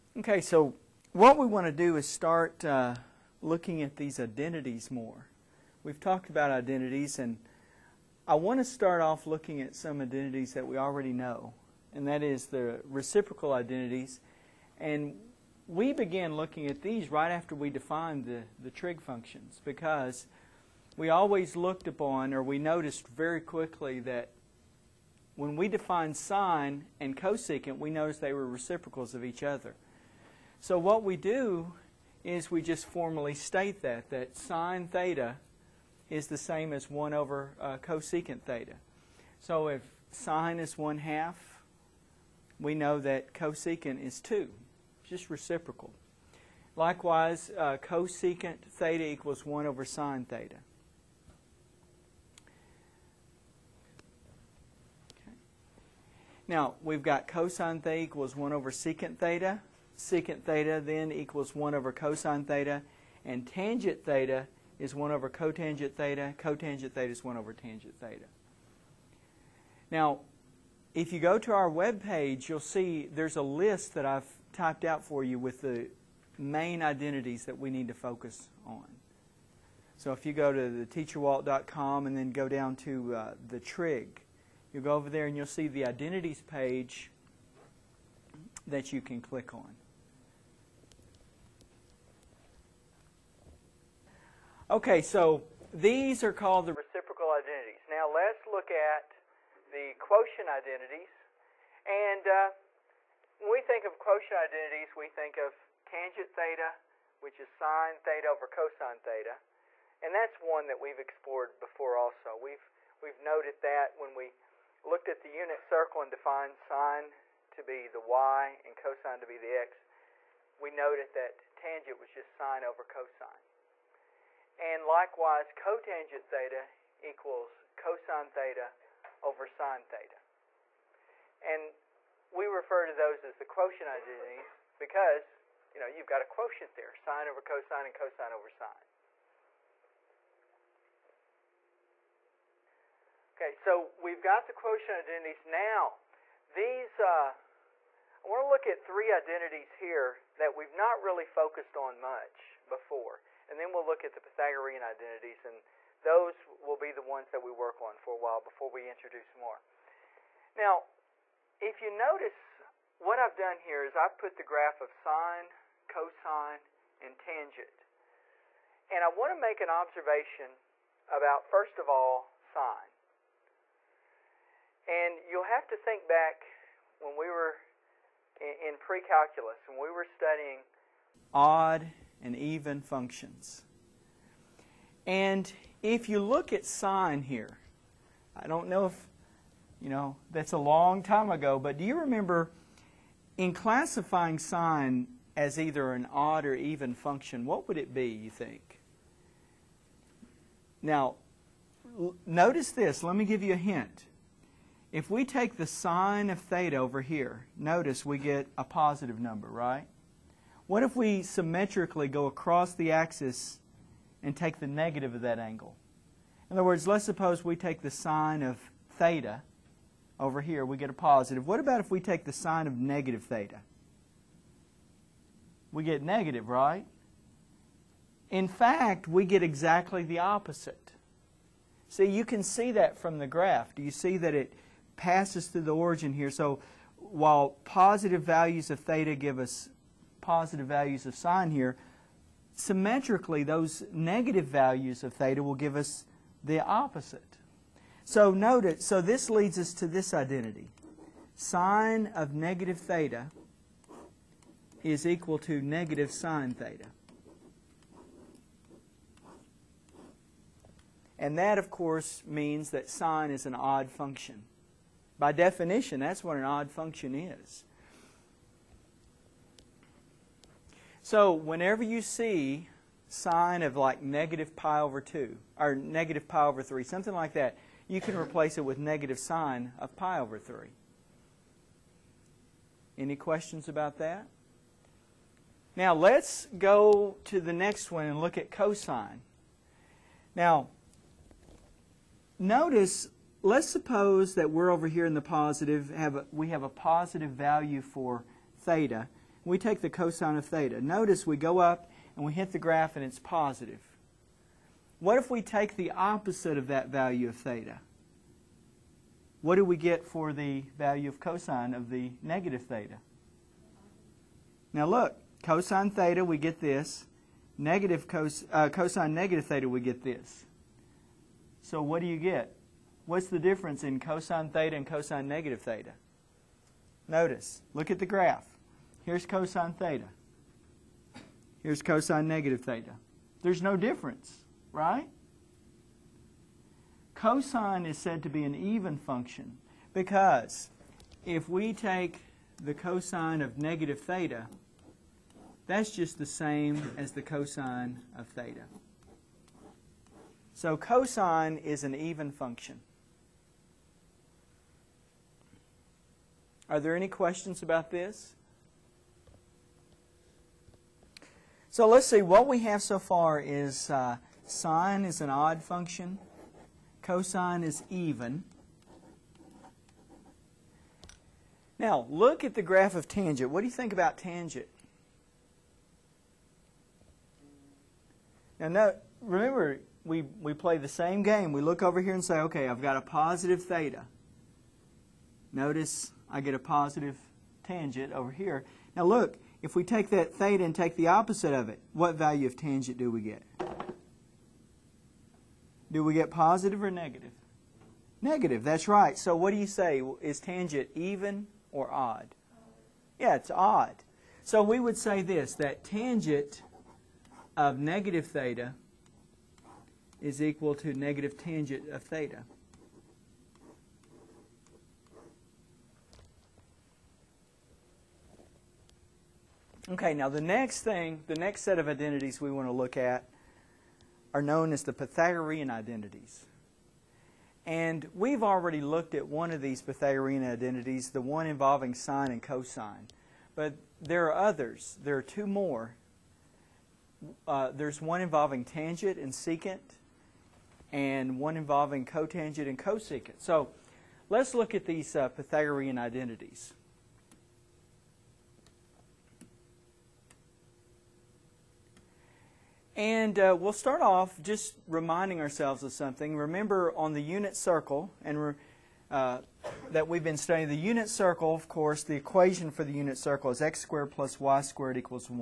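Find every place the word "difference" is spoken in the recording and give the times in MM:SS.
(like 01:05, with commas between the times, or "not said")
05:23, 05:33.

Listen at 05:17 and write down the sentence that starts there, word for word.
Negative cos, uh, cosine negative theta, we get this.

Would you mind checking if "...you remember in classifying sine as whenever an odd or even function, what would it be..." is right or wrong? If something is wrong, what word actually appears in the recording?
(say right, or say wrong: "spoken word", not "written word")
wrong: "either", not "whenever".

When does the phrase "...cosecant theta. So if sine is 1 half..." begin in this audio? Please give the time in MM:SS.
00:37.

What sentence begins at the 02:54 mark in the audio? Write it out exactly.
And you'll have to think back when we were in, pre-calculus, when we were studying odd and even functions.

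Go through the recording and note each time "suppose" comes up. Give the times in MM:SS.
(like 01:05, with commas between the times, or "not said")
03:37, 04:53.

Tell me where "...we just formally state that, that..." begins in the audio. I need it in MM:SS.
00:32.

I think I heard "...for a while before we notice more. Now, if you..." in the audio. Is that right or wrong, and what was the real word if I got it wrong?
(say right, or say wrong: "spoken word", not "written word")
wrong: "introduce", not "notice".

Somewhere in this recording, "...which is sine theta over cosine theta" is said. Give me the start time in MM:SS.
01:47.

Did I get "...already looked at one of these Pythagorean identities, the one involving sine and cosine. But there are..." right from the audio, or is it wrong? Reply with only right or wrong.
right.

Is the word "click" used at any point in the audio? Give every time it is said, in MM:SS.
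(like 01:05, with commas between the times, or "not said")
01:29.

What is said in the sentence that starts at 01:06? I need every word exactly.
Cotangent theta is 1 over tangent theta.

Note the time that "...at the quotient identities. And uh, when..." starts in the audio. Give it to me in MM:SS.
01:38.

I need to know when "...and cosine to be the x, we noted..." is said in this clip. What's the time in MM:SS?
01:58.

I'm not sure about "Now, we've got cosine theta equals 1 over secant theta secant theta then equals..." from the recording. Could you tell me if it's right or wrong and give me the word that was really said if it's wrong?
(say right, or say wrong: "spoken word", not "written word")
right.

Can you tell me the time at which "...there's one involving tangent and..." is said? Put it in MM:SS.
07:17.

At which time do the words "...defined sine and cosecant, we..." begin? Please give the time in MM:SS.
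00:25.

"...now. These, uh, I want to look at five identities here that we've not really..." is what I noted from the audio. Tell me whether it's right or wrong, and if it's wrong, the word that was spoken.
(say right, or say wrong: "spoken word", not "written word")
wrong: "three", not "five".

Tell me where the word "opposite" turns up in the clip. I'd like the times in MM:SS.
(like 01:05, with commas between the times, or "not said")
03:50, 04:06, 05:05, 06:31.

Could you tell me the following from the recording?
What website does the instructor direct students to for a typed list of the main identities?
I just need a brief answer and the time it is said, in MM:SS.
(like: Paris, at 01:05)
teacherwalt.com, at 01:20.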